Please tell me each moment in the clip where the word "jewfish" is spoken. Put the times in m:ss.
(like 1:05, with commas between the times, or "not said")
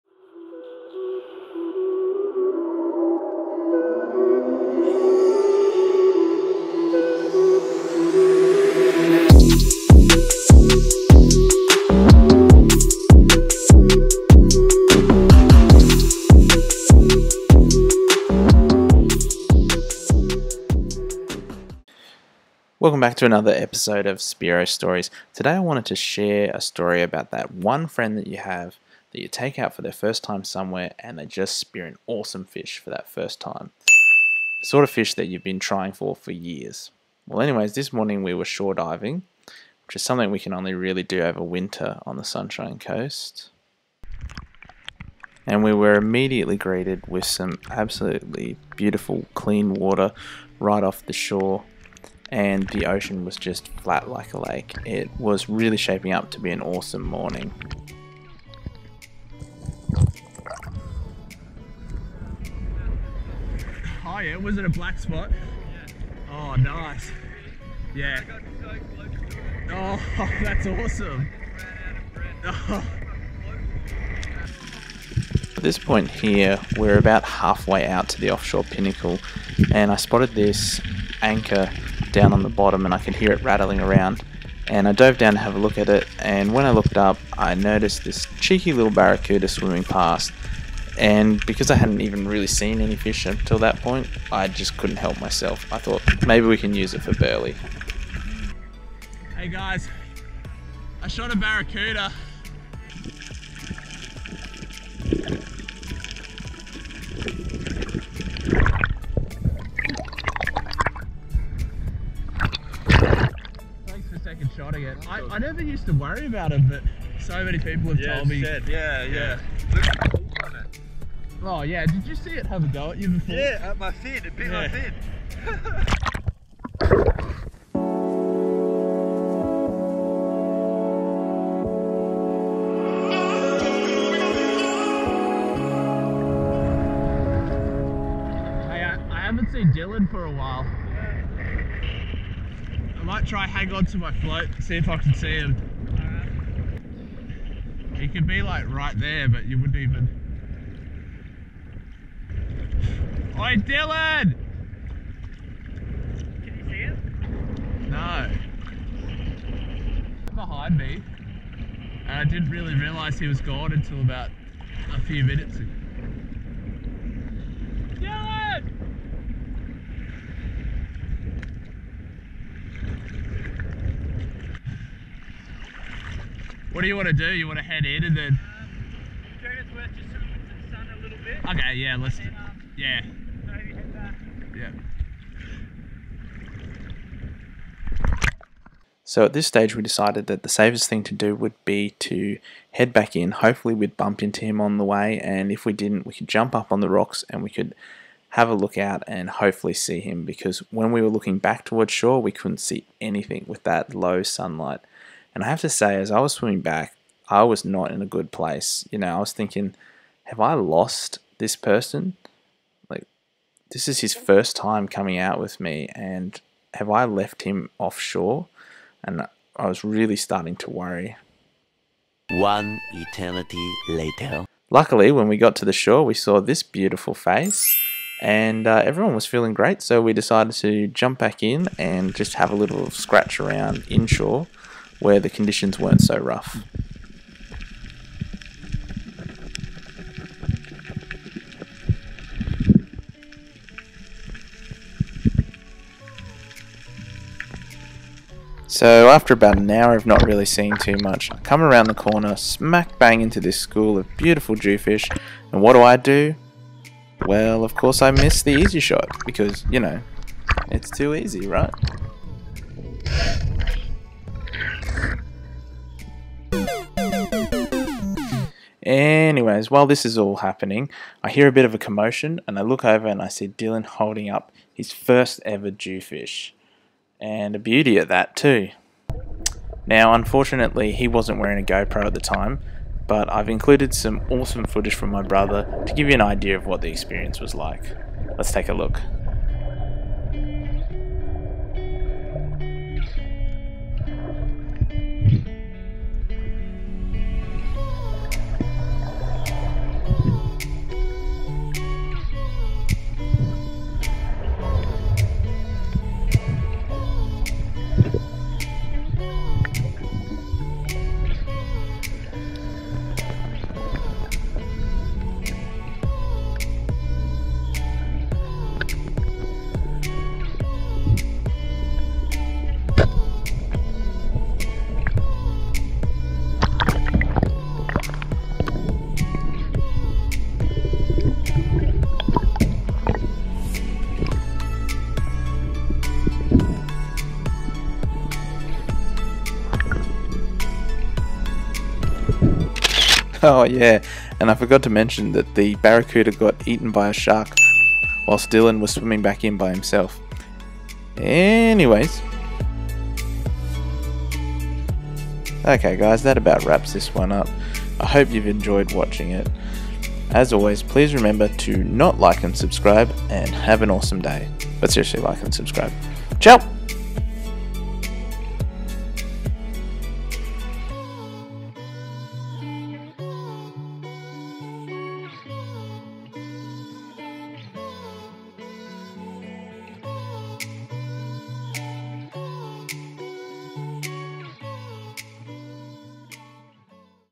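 4:14, 4:35.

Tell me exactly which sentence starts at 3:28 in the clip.
You know, I was thinking, have I lost this person?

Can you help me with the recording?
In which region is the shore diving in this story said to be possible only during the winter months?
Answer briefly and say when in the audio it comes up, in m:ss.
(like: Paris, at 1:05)
Sunshine Coast, at 0:42.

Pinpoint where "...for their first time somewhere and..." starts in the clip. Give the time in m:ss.
0:29.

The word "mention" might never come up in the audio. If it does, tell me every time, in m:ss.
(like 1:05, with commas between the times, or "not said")
5:44.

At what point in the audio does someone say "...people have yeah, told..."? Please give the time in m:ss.
1:57.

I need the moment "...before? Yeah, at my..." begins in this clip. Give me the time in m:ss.
2:03.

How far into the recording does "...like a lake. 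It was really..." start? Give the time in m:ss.
0:54.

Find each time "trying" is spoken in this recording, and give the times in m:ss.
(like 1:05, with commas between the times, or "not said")
0:35.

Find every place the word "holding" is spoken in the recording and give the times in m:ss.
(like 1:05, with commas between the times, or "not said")
4:33.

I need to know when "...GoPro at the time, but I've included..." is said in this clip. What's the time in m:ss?
4:41.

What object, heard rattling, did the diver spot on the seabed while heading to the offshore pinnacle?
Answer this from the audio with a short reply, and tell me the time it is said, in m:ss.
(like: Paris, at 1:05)
anchor, at 1:21.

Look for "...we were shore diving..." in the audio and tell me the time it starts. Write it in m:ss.
0:38.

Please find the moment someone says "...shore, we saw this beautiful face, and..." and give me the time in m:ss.
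3:45.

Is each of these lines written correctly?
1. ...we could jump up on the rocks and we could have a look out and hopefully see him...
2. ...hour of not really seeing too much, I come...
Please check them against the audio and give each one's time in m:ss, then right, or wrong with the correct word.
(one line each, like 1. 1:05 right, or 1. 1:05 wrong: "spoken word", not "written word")
1. 3:16 right
2. 4:09 right.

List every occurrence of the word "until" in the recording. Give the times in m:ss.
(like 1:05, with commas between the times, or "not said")
1:33, 2:43.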